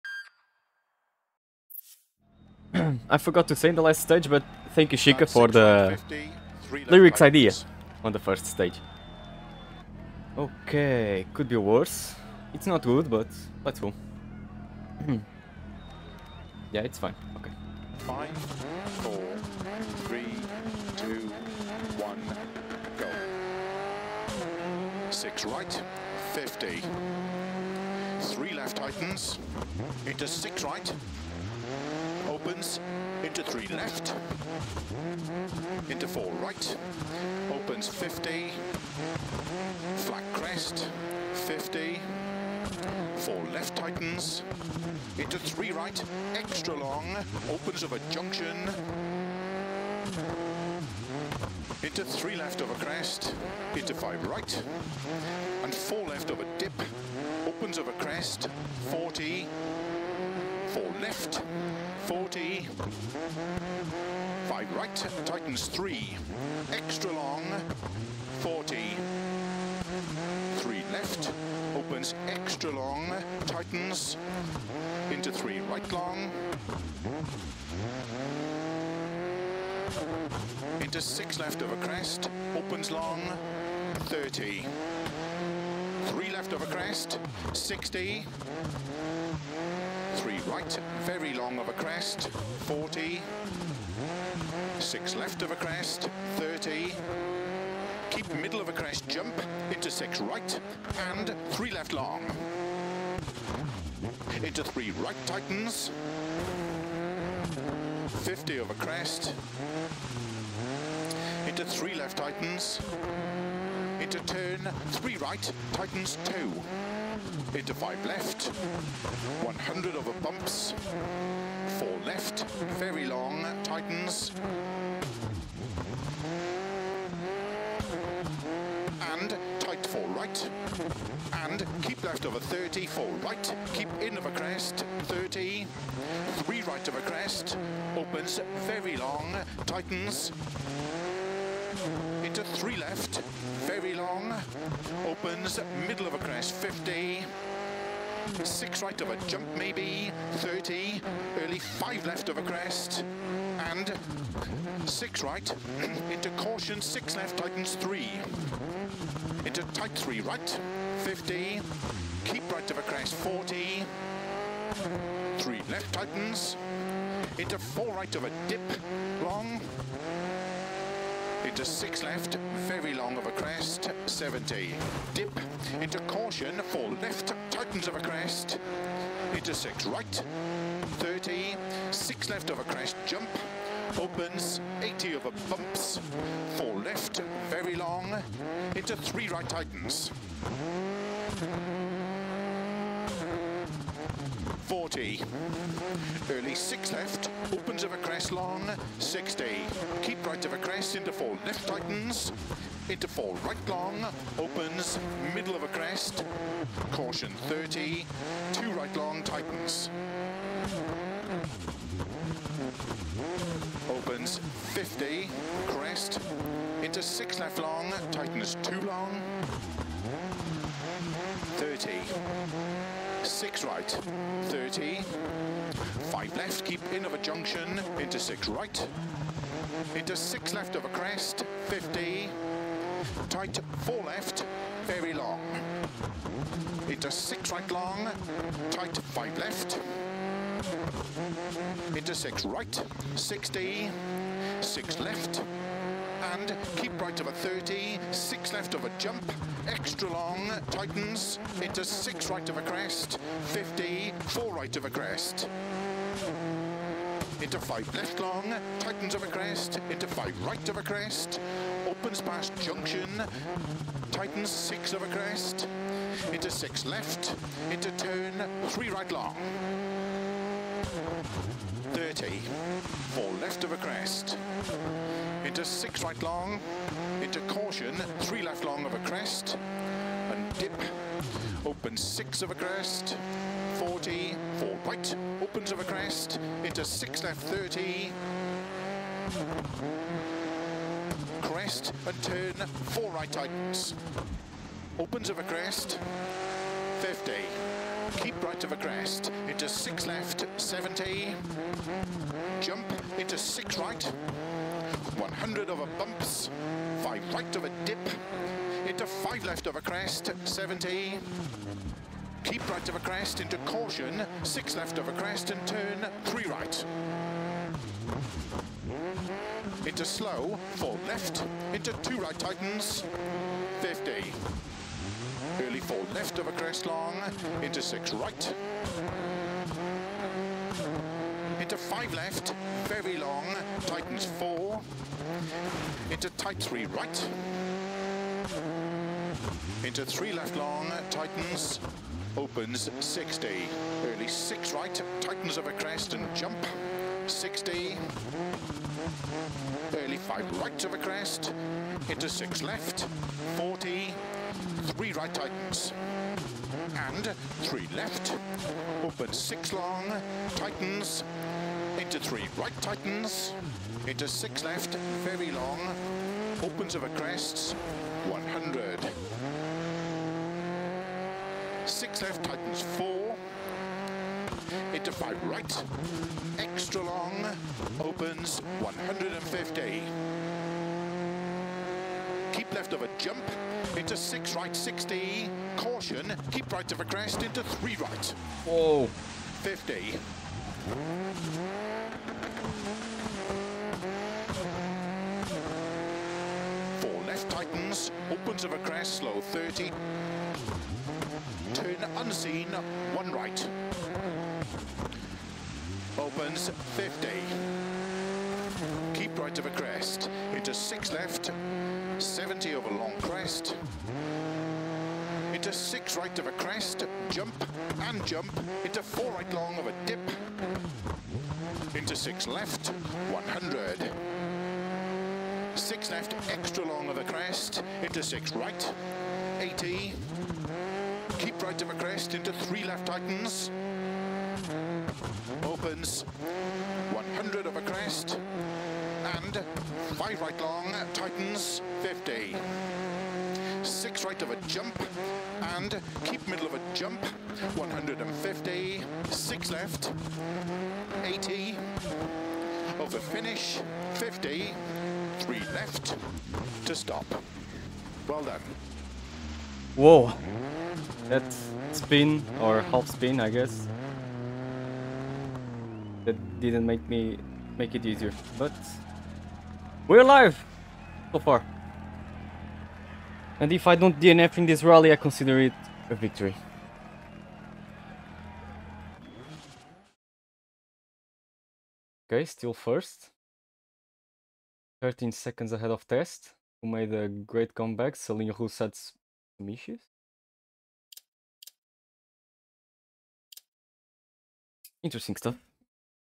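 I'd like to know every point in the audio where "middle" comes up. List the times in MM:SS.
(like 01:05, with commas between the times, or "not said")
01:38, 02:25, 03:25, 07:26.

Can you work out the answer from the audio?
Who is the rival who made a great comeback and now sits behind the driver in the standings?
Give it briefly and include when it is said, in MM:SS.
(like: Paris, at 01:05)
Test, at 08:06.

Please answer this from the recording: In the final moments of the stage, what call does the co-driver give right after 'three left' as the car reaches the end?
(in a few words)
to stop.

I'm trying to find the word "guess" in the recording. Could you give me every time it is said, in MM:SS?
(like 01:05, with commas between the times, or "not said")
07:43.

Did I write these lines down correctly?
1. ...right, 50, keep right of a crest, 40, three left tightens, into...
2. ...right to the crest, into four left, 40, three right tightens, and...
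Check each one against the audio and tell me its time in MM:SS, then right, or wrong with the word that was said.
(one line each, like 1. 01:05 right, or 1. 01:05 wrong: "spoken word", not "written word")
1. 02:40 right
2. 05:50 wrong: "six", not "four".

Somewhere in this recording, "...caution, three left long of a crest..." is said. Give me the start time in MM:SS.
04:37.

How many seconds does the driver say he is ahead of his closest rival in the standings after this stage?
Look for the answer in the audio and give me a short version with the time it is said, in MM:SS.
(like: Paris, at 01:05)
13, at 08:05.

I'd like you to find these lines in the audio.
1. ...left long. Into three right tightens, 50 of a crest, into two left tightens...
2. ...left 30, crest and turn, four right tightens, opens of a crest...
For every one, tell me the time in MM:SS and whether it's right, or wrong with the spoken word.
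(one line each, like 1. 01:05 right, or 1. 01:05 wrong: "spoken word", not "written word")
1. 01:41 wrong: "three", not "two"
2. 04:47 right.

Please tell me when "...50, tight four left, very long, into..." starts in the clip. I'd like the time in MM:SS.
03:51.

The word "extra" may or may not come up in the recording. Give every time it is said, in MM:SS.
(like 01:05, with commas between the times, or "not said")
00:46, 01:06, 01:12, 04:09, 06:16, 07:06.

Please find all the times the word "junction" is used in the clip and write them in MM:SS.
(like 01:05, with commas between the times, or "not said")
00:48, 03:47, 04:22.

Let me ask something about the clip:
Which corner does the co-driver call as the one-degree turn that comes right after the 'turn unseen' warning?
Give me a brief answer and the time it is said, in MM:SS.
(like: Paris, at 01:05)
one right, at 06:43.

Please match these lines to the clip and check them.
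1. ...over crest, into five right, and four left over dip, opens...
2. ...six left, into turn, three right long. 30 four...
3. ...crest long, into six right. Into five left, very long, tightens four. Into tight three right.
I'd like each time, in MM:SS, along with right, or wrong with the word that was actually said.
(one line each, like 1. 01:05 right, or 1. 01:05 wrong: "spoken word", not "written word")
1. 00:52 right
2. 04:26 right
3. 05:26 right.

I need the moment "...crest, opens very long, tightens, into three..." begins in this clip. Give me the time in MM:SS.
02:17.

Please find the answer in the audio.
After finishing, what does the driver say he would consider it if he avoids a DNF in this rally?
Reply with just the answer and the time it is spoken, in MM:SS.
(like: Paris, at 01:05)
a victory, at 07:56.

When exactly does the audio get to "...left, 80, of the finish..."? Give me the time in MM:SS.
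07:29.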